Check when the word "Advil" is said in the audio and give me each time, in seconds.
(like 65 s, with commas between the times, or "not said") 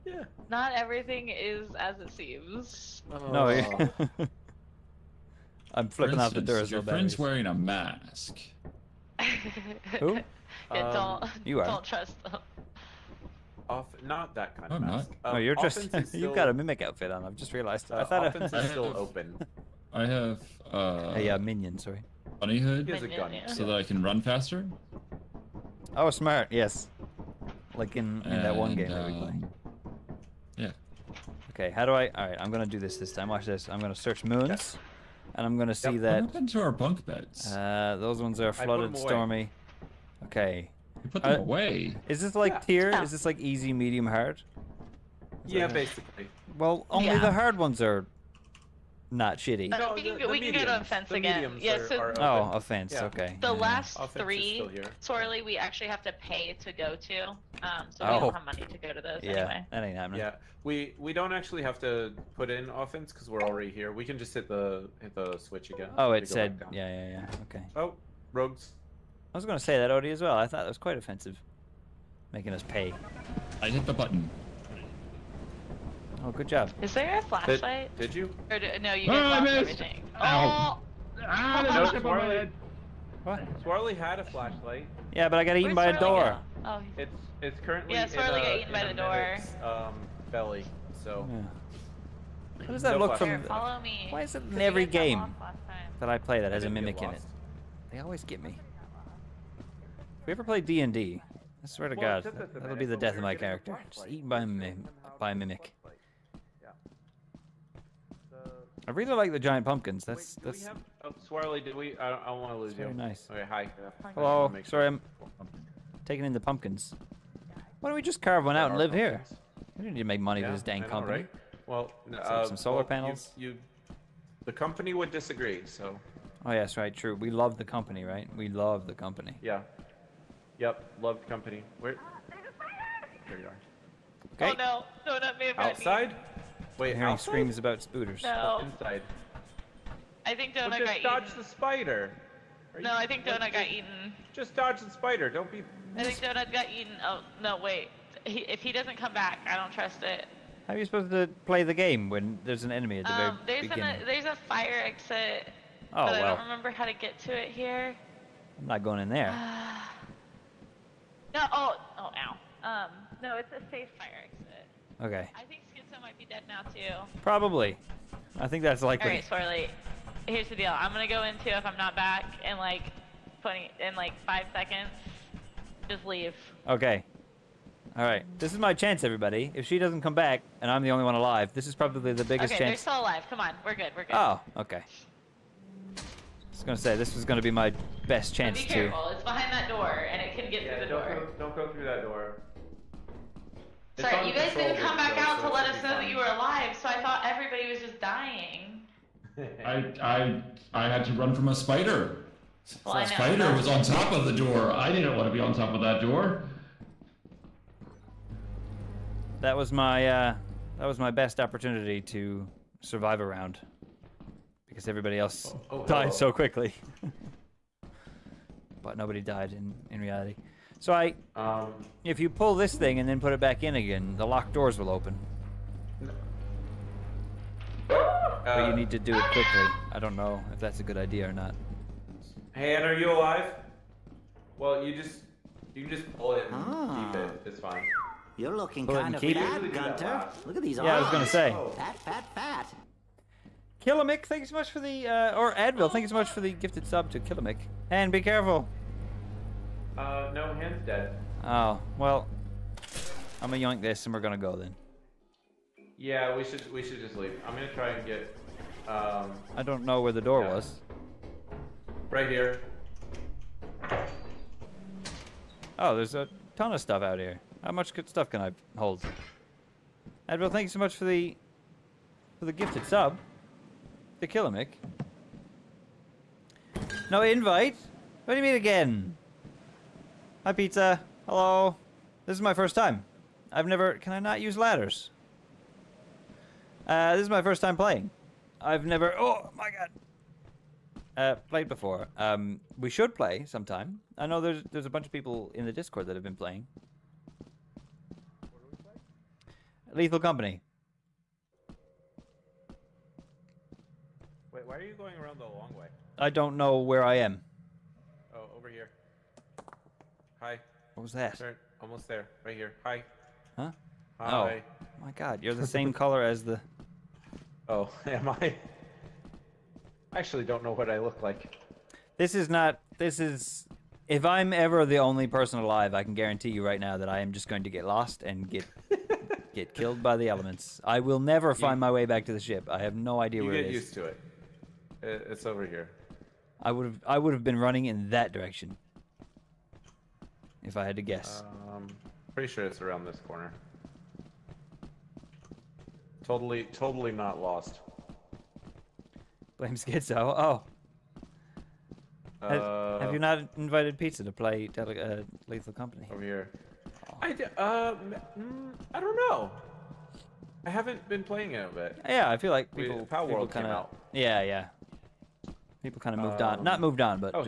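245 s, 270 s.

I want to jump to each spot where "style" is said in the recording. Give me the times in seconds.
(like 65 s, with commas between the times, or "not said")
not said.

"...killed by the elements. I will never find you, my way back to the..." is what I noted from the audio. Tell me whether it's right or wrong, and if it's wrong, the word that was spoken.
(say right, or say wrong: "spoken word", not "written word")
right.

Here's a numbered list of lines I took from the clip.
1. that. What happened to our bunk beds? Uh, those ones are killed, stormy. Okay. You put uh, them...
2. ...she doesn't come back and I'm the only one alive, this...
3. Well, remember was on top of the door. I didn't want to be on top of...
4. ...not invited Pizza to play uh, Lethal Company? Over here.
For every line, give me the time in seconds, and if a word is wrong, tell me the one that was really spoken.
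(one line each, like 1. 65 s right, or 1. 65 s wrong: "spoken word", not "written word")
1. 36 s wrong: "flooded", not "killed"
2. 179 s right
3. 202 s wrong: "spider", not "remember"
4. 353 s right.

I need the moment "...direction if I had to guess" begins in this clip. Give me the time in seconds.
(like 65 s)
338 s.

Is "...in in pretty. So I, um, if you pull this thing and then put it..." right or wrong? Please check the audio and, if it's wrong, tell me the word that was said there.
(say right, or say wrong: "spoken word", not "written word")
wrong: "reality", not "pretty".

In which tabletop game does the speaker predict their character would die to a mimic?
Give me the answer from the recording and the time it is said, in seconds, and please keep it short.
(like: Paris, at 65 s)
D and D, at 100 s.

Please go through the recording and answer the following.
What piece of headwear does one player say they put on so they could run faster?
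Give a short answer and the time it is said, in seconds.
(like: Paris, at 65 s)
Bunny hood, at 22 s.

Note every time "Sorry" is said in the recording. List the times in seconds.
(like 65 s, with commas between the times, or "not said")
21 s, 114 s, 193 s.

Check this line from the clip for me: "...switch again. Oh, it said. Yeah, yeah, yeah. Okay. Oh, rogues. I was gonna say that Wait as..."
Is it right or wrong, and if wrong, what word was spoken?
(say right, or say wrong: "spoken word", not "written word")
wrong: "Odie", not "Wait".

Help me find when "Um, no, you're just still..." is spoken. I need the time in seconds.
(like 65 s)
15 s.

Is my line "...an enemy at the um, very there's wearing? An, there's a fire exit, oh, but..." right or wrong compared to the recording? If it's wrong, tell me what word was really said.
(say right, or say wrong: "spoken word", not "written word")
wrong: "beginning", not "wearing".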